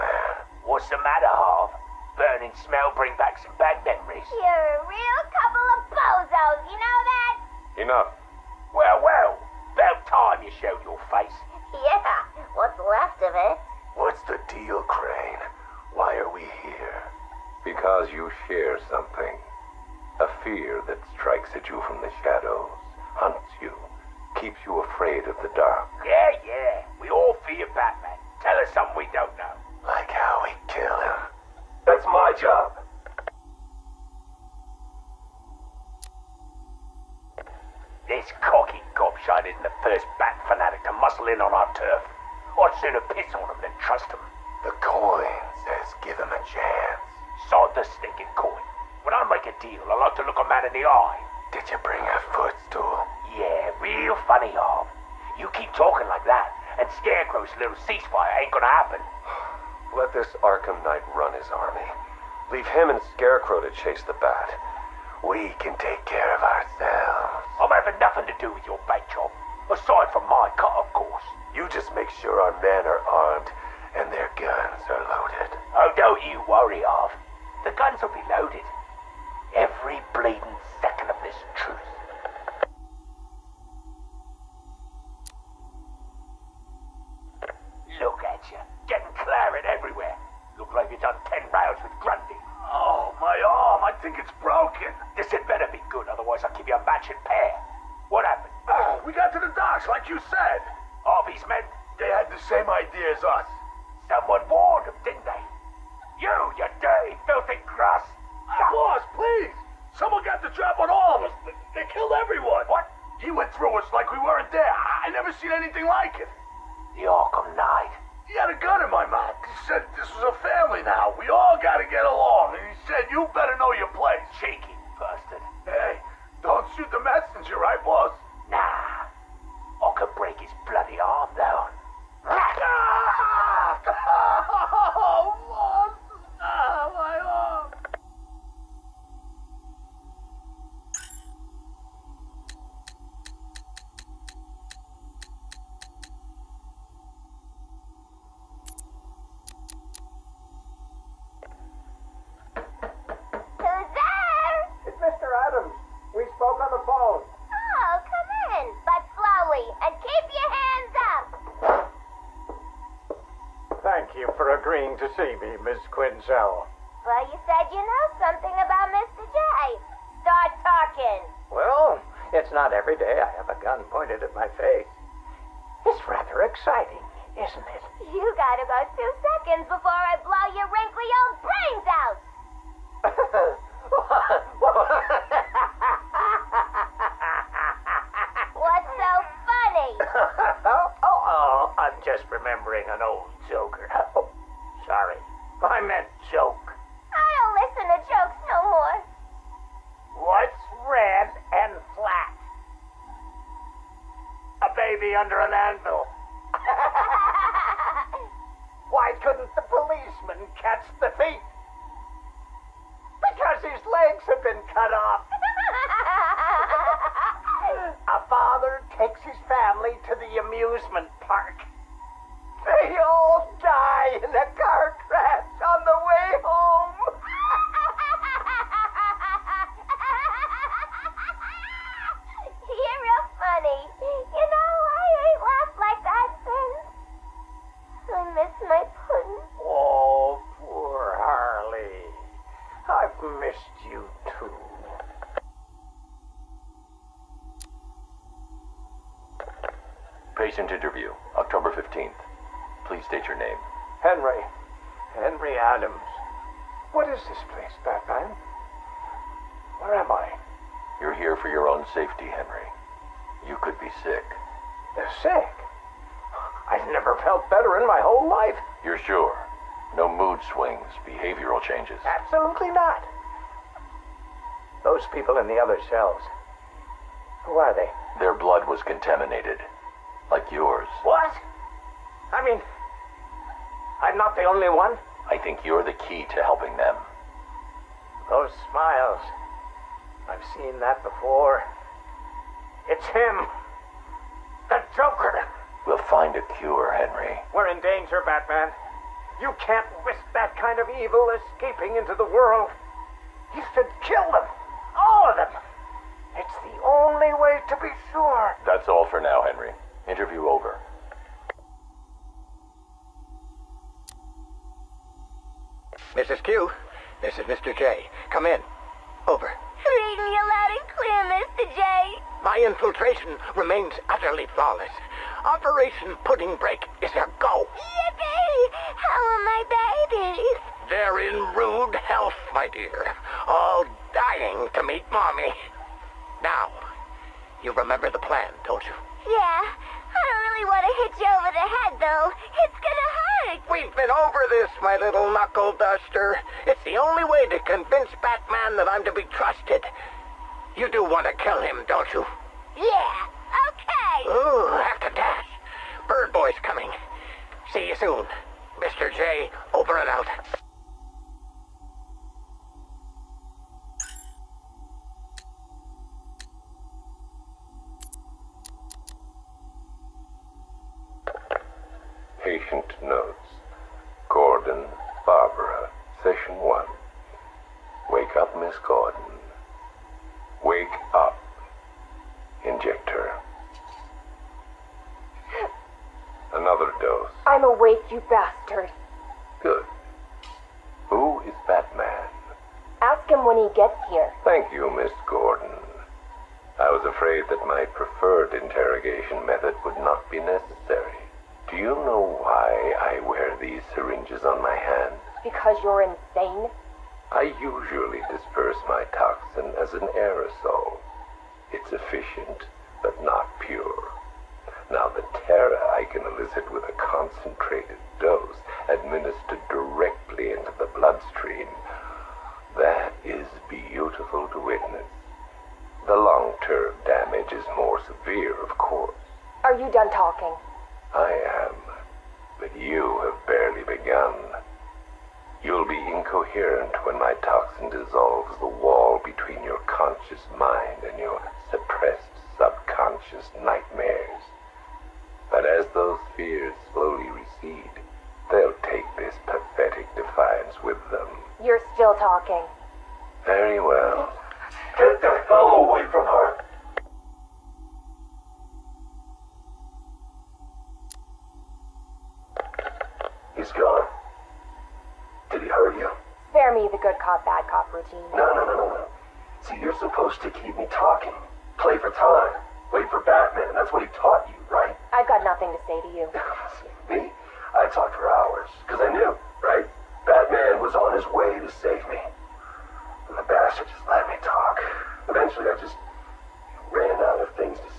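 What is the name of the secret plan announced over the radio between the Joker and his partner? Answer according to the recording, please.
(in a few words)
Operation Pudding Break.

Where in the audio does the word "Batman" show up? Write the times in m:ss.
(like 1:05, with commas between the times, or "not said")
0:27, 4:58, 5:48, 6:31, 7:53, 8:00.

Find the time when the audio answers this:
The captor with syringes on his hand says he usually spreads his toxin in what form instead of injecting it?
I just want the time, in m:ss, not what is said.
6:49.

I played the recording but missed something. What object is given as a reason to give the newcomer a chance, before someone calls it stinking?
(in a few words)
The coin.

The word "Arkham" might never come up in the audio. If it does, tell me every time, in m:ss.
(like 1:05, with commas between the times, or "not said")
1:00, 1:57.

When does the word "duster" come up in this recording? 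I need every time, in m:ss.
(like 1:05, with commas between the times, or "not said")
5:45.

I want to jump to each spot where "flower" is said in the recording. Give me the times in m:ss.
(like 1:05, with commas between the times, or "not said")
not said.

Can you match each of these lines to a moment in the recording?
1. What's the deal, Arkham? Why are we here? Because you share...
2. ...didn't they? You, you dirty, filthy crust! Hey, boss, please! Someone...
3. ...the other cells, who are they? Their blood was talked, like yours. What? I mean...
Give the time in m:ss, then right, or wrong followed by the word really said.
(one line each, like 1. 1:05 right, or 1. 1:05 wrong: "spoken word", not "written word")
1. 0:13 wrong: "Crane", not "Arkham"
2. 1:45 right
3. 4:35 wrong: "contaminated", not "talked".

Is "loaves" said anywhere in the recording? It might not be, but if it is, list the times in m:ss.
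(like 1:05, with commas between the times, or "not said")
not said.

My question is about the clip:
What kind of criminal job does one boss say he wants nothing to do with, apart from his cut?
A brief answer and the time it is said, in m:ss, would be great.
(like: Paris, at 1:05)
Bank job, at 1:08.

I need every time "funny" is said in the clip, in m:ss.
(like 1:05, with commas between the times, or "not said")
0:54.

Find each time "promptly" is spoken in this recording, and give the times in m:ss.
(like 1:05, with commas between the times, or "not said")
not said.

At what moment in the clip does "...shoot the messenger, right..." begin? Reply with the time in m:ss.
2:06.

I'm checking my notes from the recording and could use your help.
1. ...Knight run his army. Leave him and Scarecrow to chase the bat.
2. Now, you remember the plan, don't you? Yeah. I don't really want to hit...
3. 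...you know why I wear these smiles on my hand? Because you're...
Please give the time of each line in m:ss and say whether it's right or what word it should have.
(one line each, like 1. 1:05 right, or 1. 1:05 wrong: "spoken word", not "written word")
1. 1:00 right
2. 5:36 right
3. 6:41 wrong: "syringes", not "smiles".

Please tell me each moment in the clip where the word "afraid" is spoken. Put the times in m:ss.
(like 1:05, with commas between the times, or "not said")
0:24, 6:37.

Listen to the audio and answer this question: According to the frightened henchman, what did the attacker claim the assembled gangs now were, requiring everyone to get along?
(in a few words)
A family.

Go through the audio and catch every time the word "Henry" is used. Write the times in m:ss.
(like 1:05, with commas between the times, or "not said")
4:22, 4:56, 5:09.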